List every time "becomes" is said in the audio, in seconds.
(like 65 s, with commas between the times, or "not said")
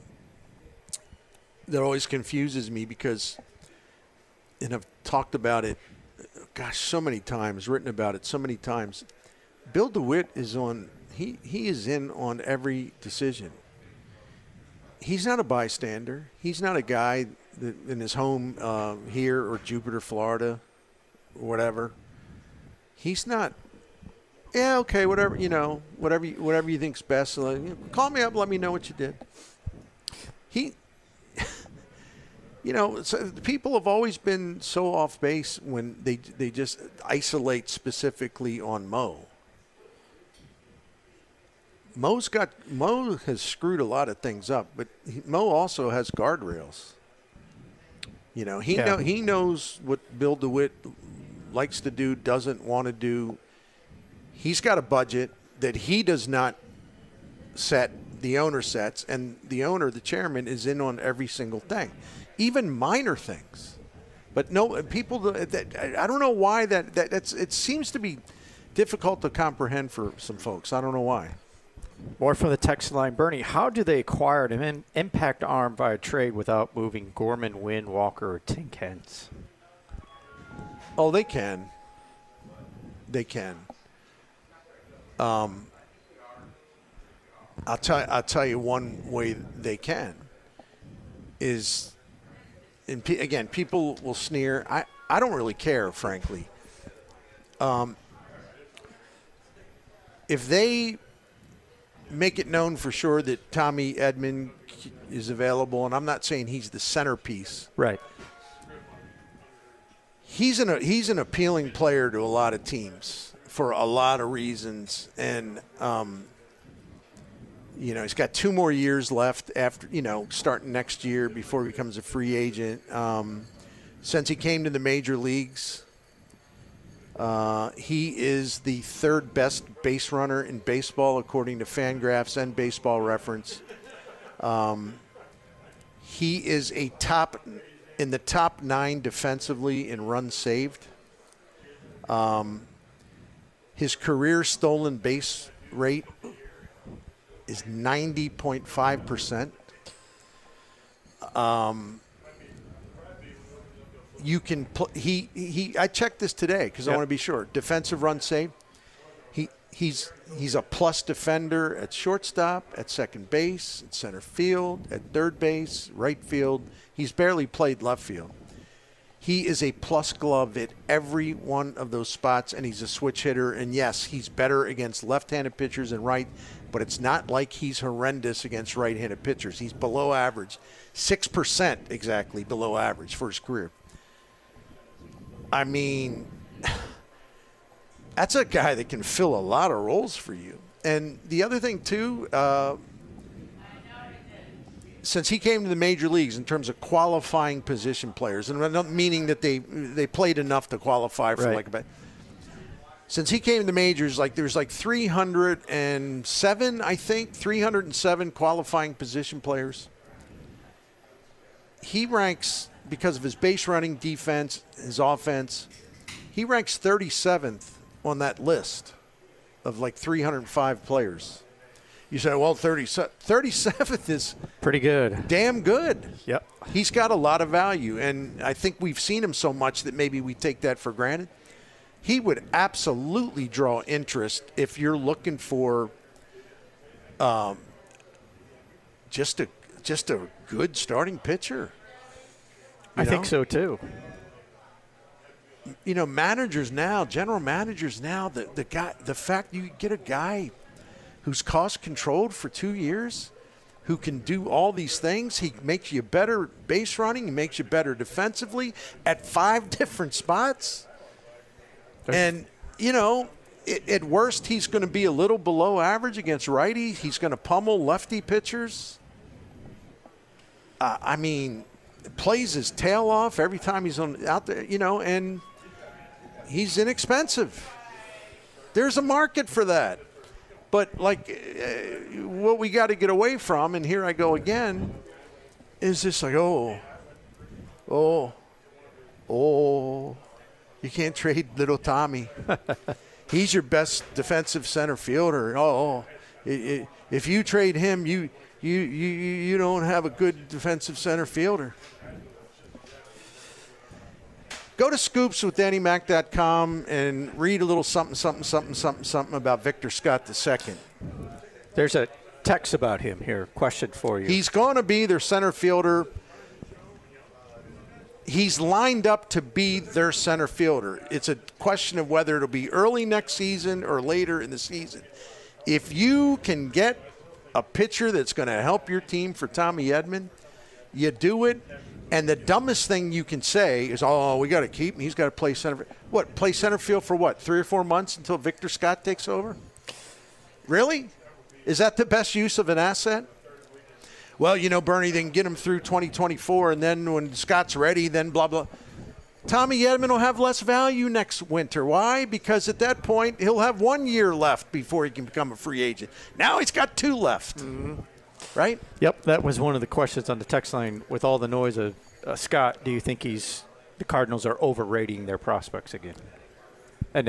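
121 s, 355 s.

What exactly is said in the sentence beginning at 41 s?
Mo's got Mo has screwed a lot of things up, but he, Mo also has guardrails.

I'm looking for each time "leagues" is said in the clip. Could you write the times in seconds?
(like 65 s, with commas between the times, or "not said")
125 s, 196 s.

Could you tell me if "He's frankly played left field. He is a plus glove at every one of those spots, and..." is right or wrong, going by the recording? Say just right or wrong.
wrong.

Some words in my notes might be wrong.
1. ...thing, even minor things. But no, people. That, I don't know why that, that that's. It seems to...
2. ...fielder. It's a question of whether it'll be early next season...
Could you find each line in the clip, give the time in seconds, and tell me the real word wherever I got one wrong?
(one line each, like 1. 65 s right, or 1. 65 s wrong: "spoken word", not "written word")
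1. 61 s right
2. 320 s right.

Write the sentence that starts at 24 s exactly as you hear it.
Yeah, okay, whatever you know, whatever you, whatever you think's best.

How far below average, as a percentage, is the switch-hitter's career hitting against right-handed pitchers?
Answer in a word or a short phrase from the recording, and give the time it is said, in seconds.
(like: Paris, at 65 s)
6%, at 180 s.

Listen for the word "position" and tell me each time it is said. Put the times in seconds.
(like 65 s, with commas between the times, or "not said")
197 s, 208 s.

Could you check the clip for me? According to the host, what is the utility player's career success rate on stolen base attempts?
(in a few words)
90.5 percent.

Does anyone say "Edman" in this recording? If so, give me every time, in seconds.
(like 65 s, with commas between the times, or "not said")
103 s, 329 s, 349 s.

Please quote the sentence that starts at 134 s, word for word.
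Um, he is a top in the top nine defensively in runs saved.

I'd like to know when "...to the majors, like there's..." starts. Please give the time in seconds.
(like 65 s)
203 s.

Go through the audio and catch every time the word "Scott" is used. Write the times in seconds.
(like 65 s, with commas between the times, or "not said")
309 s, 338 s, 347 s, 362 s.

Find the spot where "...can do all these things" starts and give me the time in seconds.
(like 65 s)
253 s.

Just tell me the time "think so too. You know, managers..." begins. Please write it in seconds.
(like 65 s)
243 s.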